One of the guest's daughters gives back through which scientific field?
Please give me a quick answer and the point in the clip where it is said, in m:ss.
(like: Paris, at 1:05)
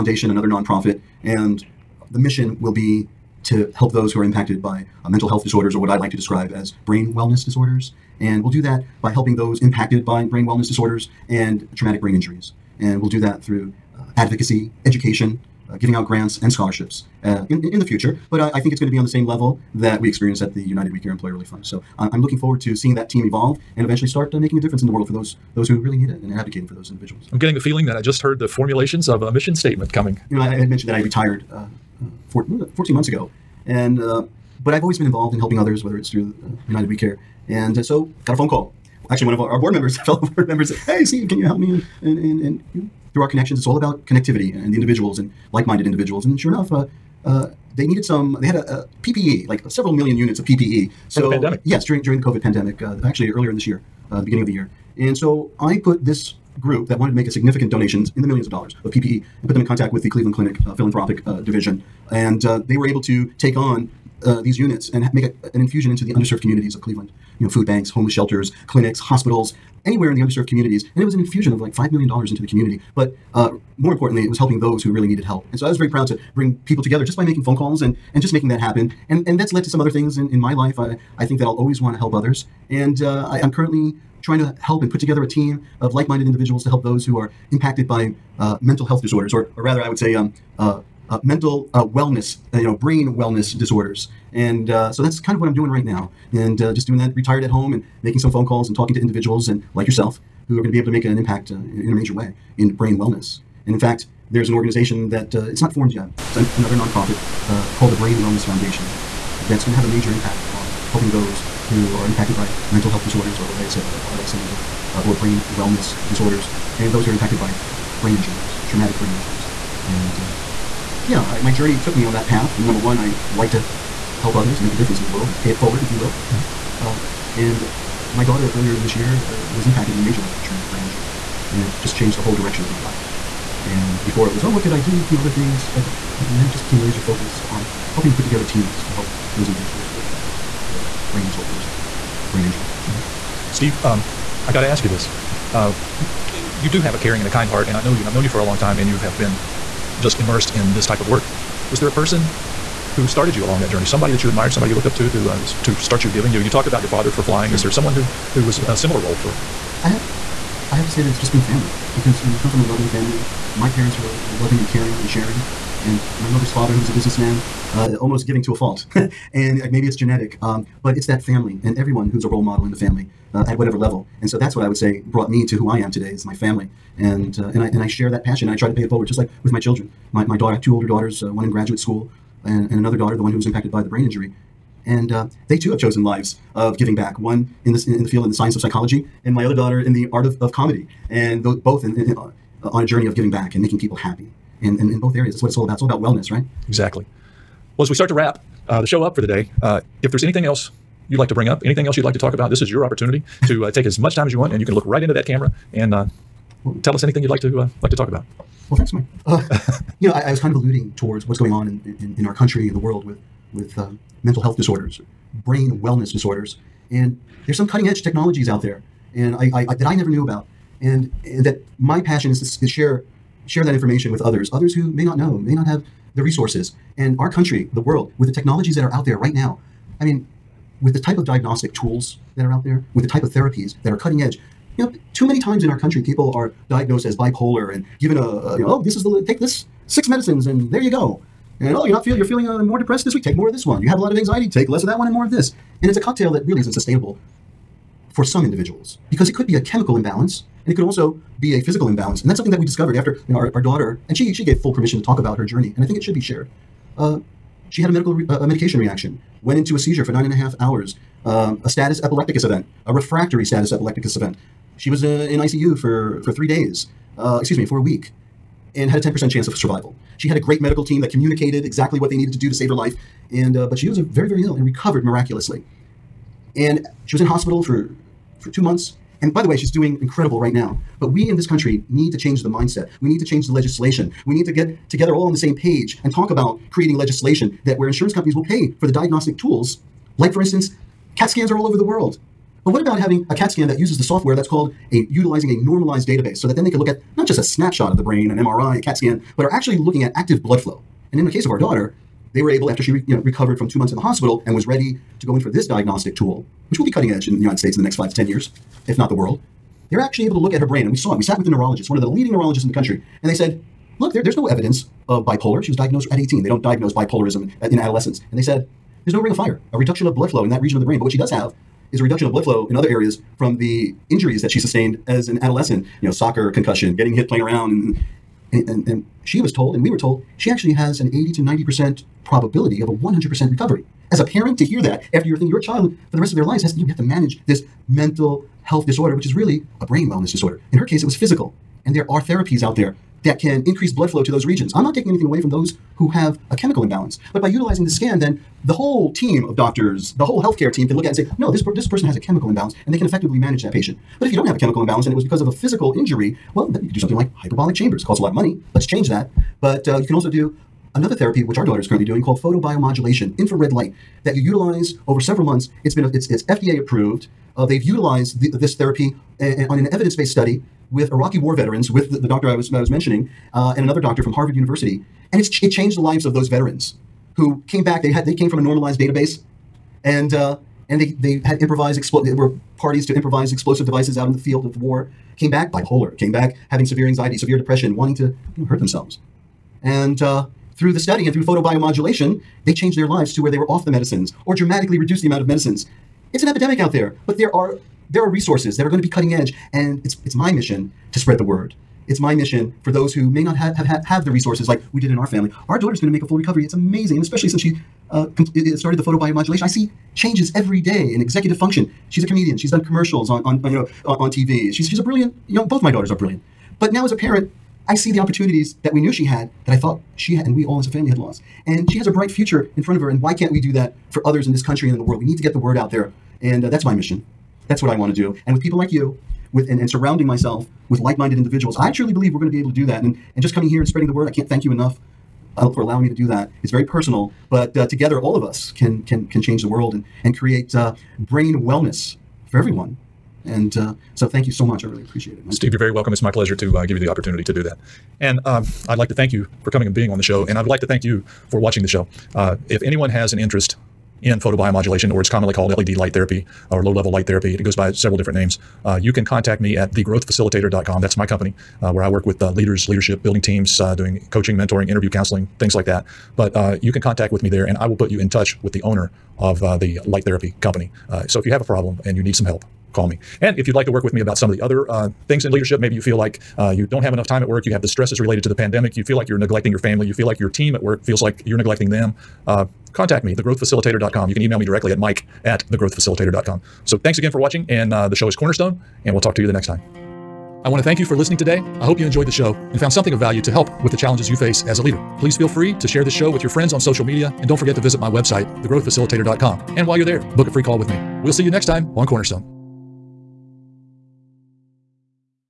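psychology, at 3:08.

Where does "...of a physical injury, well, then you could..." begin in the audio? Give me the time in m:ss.
5:55.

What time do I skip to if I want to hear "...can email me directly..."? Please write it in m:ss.
8:04.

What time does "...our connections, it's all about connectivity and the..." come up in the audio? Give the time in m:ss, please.
0:43.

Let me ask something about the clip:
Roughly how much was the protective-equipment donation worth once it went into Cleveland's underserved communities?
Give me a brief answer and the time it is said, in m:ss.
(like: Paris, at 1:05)
$5 million, at 1:11.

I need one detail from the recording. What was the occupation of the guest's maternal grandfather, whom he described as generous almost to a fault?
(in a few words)
businessman.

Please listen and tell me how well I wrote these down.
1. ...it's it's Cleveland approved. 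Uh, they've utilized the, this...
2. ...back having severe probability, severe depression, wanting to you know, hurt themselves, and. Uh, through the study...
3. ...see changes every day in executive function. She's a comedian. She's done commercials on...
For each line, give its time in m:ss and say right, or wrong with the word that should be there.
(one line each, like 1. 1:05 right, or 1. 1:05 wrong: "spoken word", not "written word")
1. 6:06 wrong: "FDA", not "Cleveland"
2. 6:26 wrong: "anxiety", not "probability"
3. 6:49 right.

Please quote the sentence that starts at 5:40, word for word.
In her case, it was physical.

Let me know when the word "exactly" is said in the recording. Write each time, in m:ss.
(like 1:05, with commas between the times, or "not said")
3:16, 4:31.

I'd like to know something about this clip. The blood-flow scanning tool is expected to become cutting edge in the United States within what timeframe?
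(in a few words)
5 to 10 years.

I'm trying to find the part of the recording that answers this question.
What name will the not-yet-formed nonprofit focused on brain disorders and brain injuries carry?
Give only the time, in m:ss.
1:47.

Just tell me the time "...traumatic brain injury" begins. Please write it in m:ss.
2:10.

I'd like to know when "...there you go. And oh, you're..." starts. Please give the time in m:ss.
4:00.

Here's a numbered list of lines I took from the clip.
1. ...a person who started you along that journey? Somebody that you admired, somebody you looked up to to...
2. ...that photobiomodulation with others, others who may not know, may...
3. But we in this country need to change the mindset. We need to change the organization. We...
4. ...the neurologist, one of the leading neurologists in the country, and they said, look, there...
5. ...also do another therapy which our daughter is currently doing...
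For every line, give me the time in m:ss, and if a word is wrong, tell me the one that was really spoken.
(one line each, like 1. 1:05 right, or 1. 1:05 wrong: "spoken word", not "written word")
1. 2:31 right
2. 3:43 wrong: "information", not "photobiomodulation"
3. 4:41 wrong: "legislation", not "organization"
4. 5:11 right
5. 6:00 right.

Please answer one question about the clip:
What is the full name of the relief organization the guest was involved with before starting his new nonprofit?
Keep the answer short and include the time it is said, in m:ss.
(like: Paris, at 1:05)
United We Care Employer Relief Fund, at 0:20.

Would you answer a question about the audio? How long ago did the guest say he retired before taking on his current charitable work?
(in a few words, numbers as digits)
14 months.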